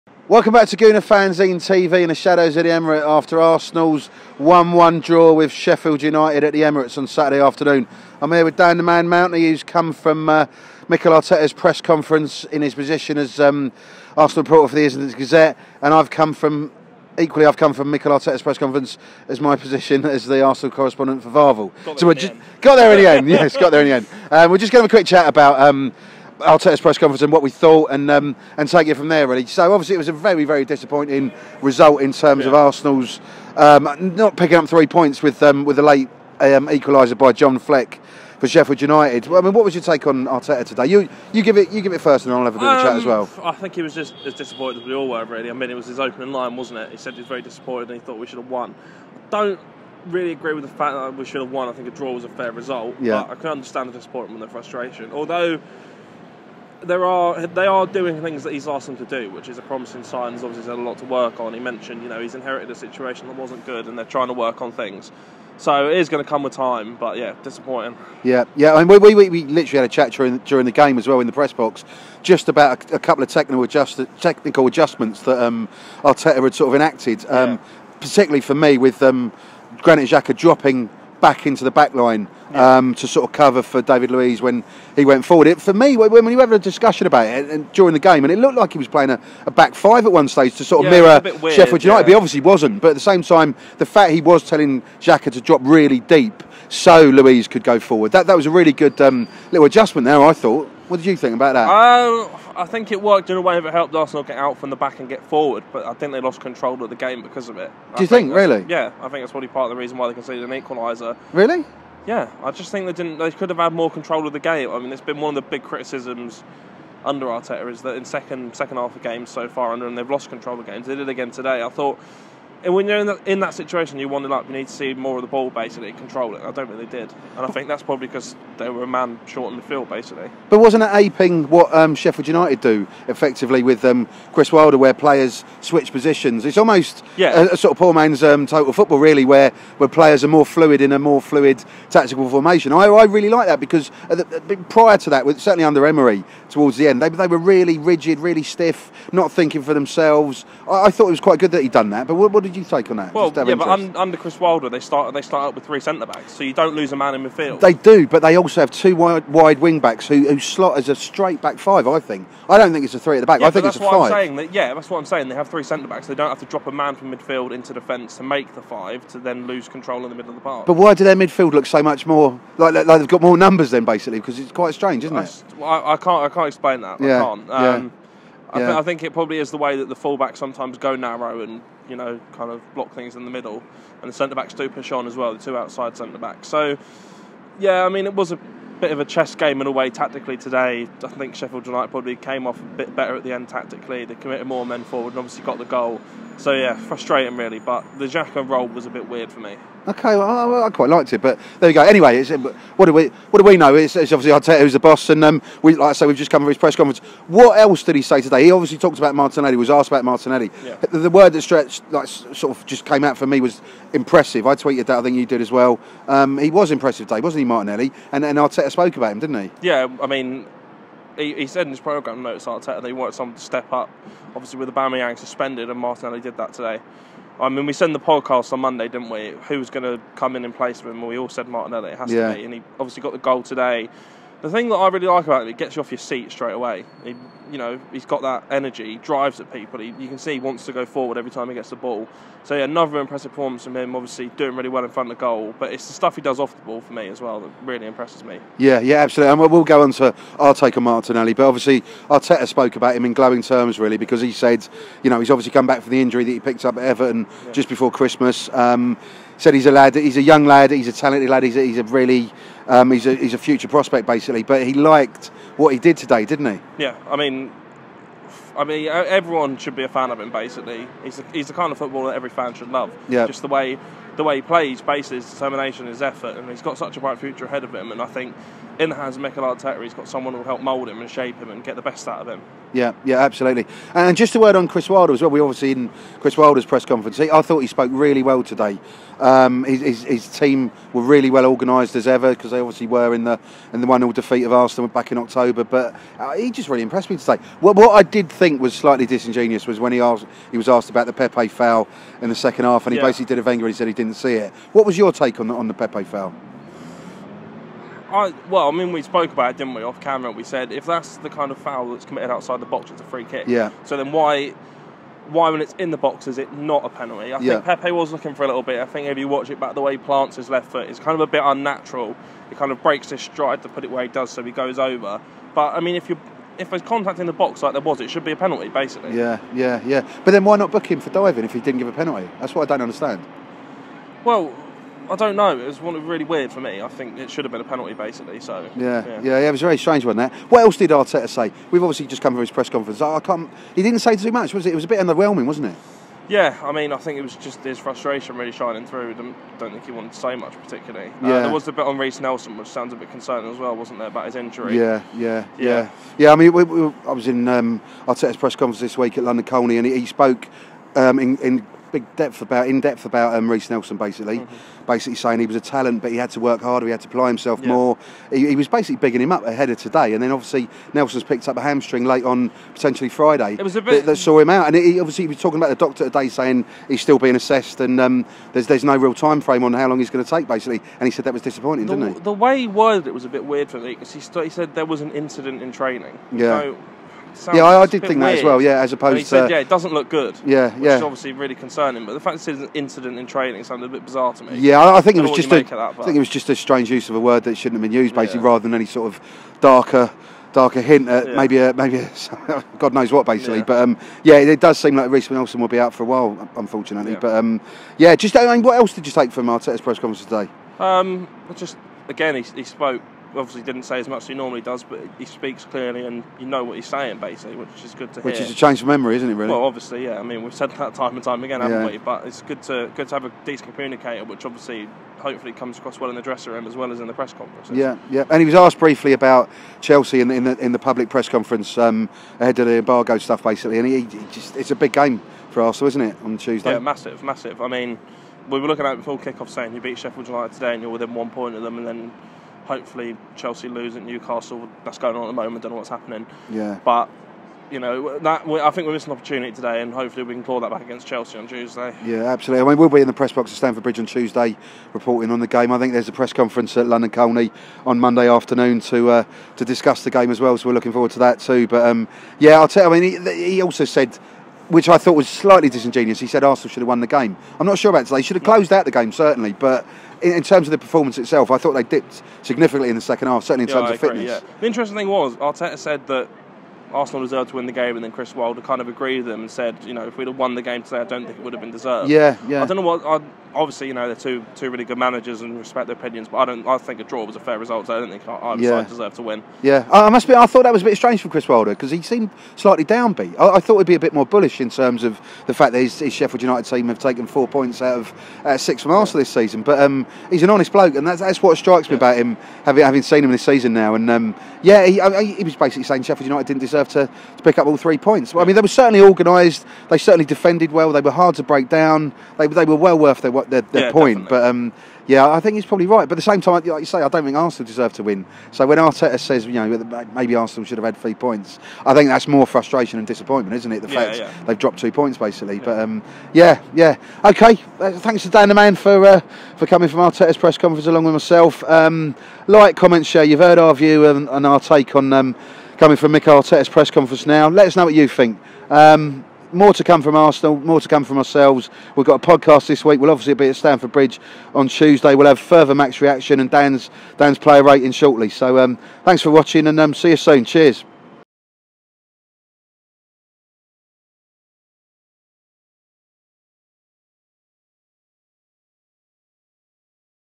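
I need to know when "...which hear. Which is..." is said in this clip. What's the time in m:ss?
6:58.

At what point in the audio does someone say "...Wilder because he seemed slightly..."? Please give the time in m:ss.
8:11.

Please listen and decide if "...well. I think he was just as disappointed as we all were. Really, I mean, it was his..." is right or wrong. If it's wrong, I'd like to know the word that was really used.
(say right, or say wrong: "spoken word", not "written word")
right.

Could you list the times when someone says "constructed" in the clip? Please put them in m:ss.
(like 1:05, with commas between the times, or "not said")
not said.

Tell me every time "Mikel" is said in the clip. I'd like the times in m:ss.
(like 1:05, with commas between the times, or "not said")
0:10, 0:17, 4:39.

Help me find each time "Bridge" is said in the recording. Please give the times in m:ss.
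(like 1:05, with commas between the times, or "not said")
7:33, 9:03.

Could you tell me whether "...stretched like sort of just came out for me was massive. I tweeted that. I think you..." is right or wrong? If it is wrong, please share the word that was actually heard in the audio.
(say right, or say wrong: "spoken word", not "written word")
wrong: "impressive", not "massive".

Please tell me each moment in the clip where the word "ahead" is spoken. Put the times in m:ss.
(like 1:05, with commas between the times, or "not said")
4:37, 6:09, 7:12.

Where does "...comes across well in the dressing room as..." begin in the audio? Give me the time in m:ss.
7:05.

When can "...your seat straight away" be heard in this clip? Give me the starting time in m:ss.
3:55.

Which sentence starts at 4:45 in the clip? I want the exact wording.
We obviously in Chris Wilder's press conference.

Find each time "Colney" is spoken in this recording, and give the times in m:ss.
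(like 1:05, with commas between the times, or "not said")
5:59, 7:37.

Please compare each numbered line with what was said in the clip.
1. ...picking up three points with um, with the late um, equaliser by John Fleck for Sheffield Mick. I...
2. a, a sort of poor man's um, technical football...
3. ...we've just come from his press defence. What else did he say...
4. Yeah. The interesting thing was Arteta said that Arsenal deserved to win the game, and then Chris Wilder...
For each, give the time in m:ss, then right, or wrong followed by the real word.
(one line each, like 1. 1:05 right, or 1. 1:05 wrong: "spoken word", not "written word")
1. 0:34 wrong: "United", not "Mick"
2. 2:17 wrong: "total", not "technical"
3. 3:26 wrong: "conference", not "defence"
4. 7:54 right.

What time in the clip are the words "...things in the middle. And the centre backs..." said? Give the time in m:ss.
3:02.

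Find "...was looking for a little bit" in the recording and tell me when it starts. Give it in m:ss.
5:17.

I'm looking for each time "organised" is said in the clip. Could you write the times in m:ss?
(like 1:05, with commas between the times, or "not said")
4:51, 8:29.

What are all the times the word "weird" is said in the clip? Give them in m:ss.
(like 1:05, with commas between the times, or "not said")
1:31, 3:19, 5:36, 6:23, 6:28.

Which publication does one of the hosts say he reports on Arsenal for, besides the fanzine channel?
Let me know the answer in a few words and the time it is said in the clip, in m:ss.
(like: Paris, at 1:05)
Islington Gazette, at 0:14.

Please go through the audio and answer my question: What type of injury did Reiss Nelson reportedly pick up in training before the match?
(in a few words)
Hamstring.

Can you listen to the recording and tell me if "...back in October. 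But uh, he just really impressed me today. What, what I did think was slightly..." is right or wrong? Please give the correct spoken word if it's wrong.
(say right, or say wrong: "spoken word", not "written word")
right.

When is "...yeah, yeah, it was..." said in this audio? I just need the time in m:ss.
5:39.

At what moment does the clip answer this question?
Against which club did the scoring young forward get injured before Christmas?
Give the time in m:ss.
4:16.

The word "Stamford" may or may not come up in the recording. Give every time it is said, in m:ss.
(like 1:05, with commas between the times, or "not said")
7:33, 9:03.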